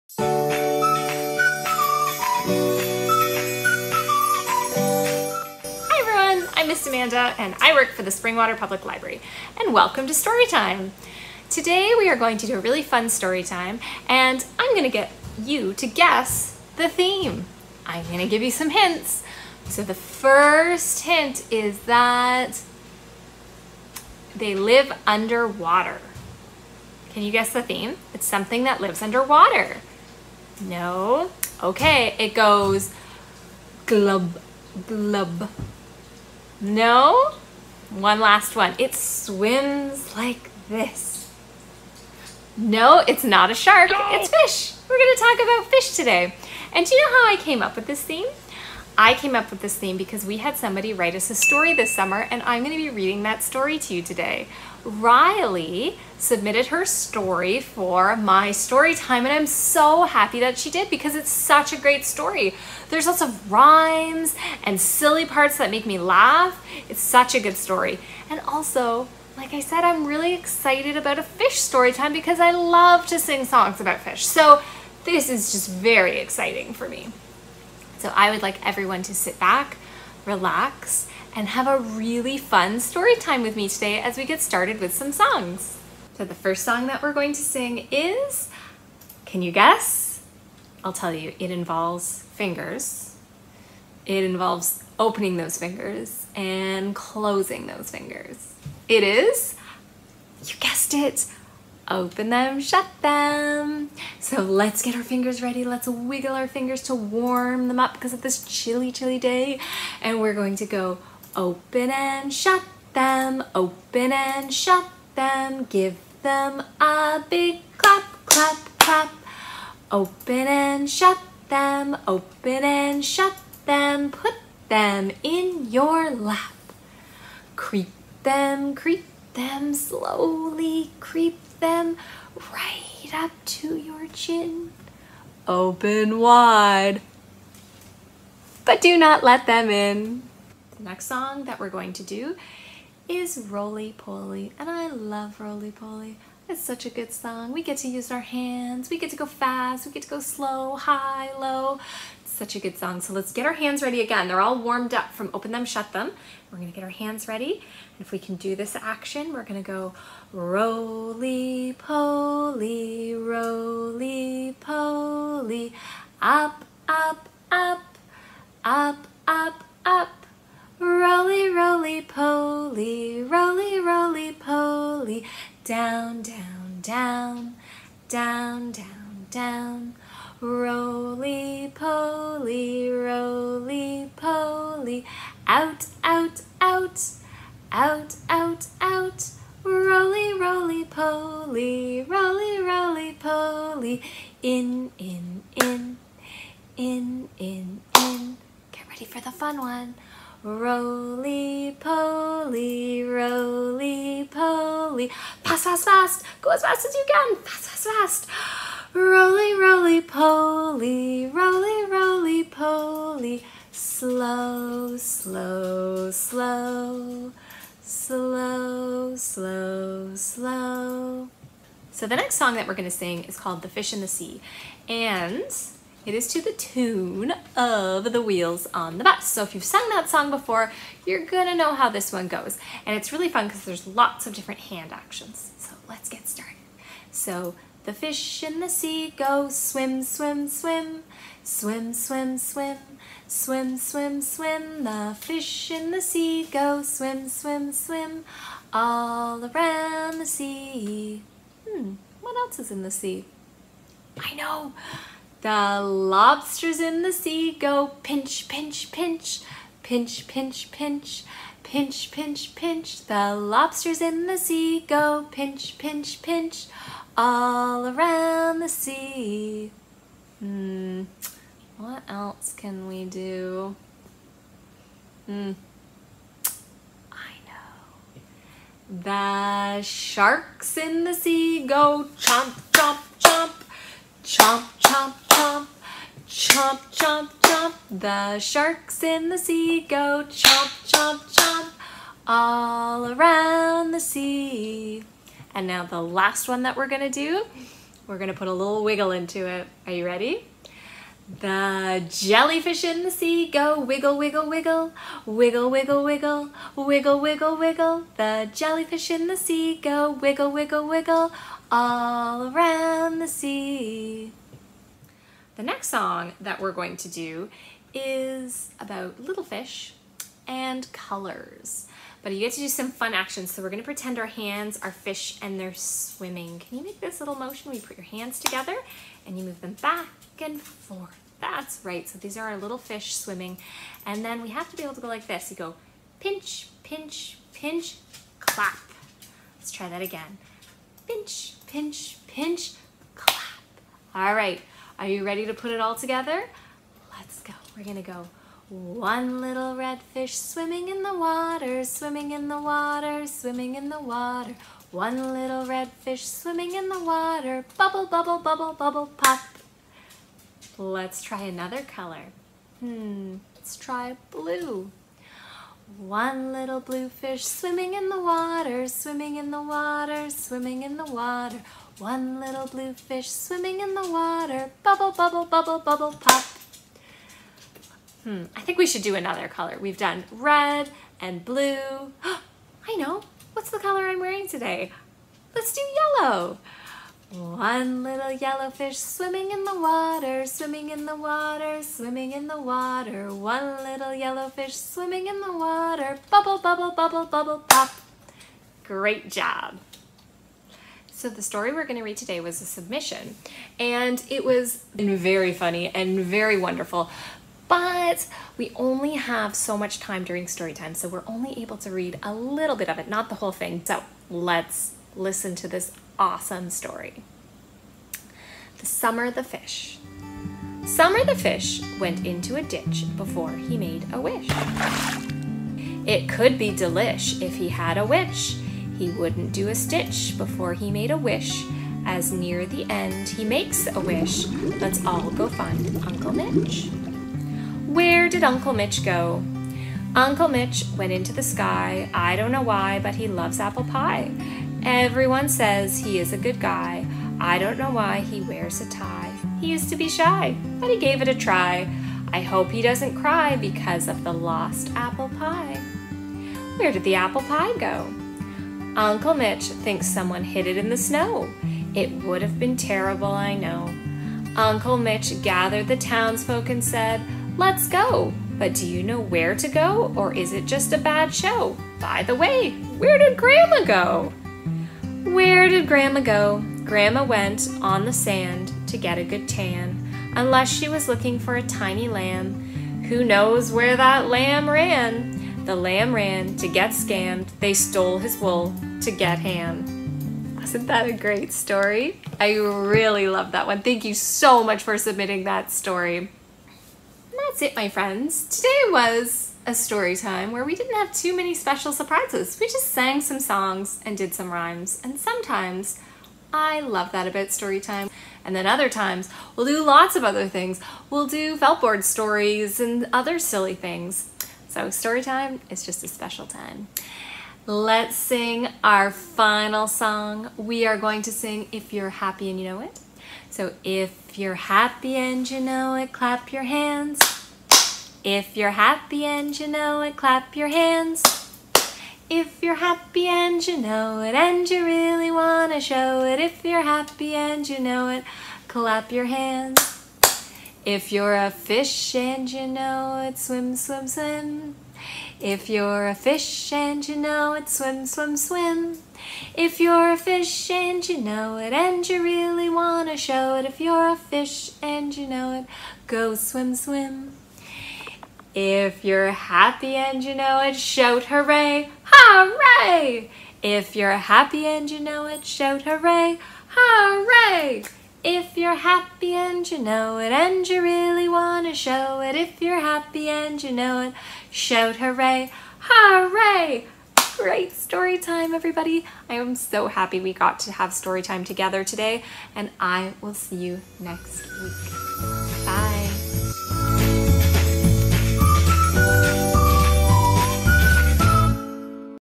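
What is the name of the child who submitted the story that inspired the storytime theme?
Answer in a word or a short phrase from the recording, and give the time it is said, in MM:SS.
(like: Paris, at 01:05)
Riley, at 00:54.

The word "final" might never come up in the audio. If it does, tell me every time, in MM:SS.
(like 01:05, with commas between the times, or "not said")
08:39.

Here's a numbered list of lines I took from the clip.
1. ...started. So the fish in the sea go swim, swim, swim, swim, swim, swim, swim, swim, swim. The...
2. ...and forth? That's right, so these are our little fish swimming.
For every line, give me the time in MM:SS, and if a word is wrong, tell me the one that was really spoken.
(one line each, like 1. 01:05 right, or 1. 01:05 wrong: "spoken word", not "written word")
1. 03:56 right
2. 05:30 right.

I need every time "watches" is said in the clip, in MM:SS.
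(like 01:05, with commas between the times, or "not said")
not said.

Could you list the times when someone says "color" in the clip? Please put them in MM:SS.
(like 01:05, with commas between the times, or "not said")
05:20, 06:01, 06:19, 06:23.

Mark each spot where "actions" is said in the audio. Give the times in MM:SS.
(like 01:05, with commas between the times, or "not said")
02:38, 03:54, 05:23.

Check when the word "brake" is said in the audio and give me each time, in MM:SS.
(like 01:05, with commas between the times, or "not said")
not said.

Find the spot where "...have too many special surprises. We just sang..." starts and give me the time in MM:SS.
08:20.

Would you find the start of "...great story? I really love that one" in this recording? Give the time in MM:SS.
08:11.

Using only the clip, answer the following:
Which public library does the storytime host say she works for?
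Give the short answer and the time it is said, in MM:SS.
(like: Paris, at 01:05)
Springwater Public Library, at 00:08.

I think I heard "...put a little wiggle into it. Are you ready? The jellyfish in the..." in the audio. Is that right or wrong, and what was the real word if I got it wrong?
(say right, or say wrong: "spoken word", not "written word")
right.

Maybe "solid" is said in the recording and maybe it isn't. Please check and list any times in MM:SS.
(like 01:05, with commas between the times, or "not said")
not said.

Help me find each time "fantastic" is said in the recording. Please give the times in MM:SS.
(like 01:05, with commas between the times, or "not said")
not said.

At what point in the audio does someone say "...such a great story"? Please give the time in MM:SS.
01:01.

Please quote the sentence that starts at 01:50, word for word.
And we're going to go Open and shut them, open and shut them, give them a big clap, clap, clap.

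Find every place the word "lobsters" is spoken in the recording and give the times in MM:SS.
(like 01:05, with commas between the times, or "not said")
04:15, 04:23.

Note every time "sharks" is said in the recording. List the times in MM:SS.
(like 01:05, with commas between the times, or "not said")
00:43, 04:39, 04:48.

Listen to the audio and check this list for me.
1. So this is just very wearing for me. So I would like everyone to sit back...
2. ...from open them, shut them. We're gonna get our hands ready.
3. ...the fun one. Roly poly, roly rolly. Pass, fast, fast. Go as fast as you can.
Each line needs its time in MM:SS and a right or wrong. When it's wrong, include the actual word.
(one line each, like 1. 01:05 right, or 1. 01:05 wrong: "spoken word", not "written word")
1. 01:14 wrong: "exciting", not "wearing"
2. 02:35 right
3. 03:19 right.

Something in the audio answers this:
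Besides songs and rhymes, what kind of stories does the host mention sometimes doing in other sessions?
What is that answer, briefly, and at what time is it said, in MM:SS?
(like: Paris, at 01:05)
felt board stories, at 08:31.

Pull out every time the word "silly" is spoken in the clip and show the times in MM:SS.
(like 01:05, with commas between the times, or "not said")
01:04, 08:33.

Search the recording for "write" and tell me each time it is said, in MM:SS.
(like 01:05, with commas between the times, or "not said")
00:50.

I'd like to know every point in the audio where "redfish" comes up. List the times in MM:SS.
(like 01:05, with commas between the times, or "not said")
05:49, 05:55.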